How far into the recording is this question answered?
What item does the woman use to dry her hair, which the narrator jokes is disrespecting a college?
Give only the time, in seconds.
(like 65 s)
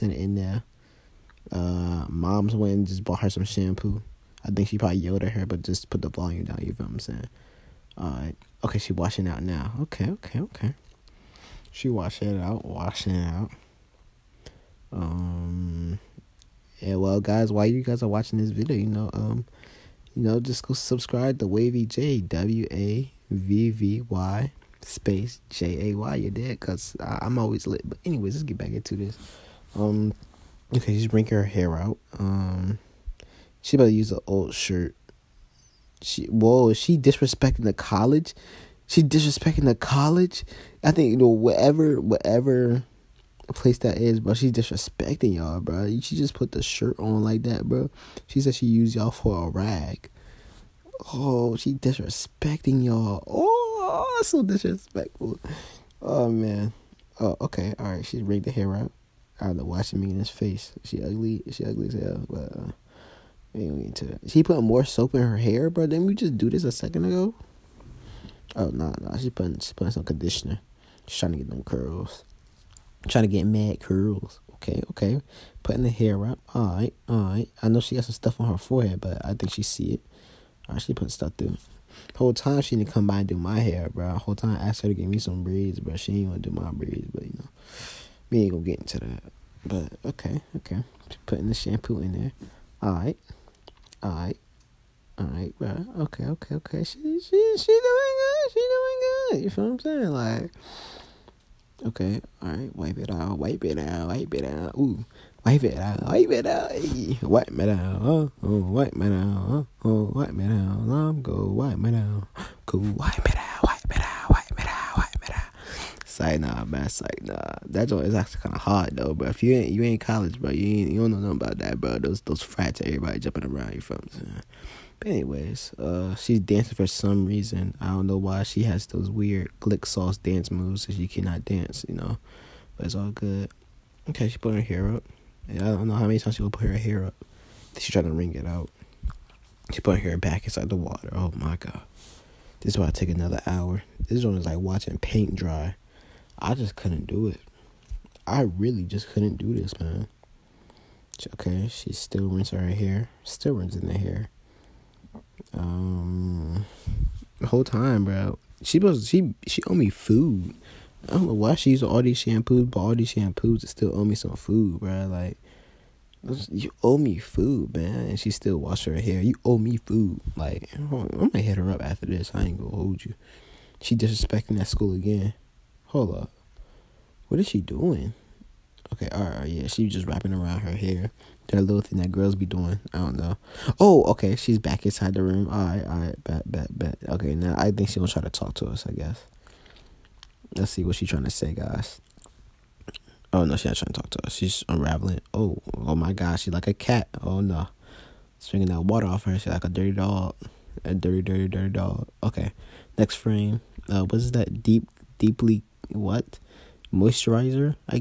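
34 s.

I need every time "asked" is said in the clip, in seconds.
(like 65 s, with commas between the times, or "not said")
84 s.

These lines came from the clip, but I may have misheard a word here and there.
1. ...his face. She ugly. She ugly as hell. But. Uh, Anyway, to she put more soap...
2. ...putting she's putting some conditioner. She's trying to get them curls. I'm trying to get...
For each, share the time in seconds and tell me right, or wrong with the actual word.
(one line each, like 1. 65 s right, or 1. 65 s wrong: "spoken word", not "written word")
1. 60 s right
2. 69 s right.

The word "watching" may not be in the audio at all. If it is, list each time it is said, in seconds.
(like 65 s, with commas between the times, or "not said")
18 s, 144 s.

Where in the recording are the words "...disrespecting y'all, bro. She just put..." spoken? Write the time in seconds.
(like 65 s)
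44 s.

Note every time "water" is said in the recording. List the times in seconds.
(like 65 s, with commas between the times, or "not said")
140 s, 198 s.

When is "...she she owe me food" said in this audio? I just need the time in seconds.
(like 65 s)
159 s.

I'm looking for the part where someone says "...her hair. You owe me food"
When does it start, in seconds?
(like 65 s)
168 s.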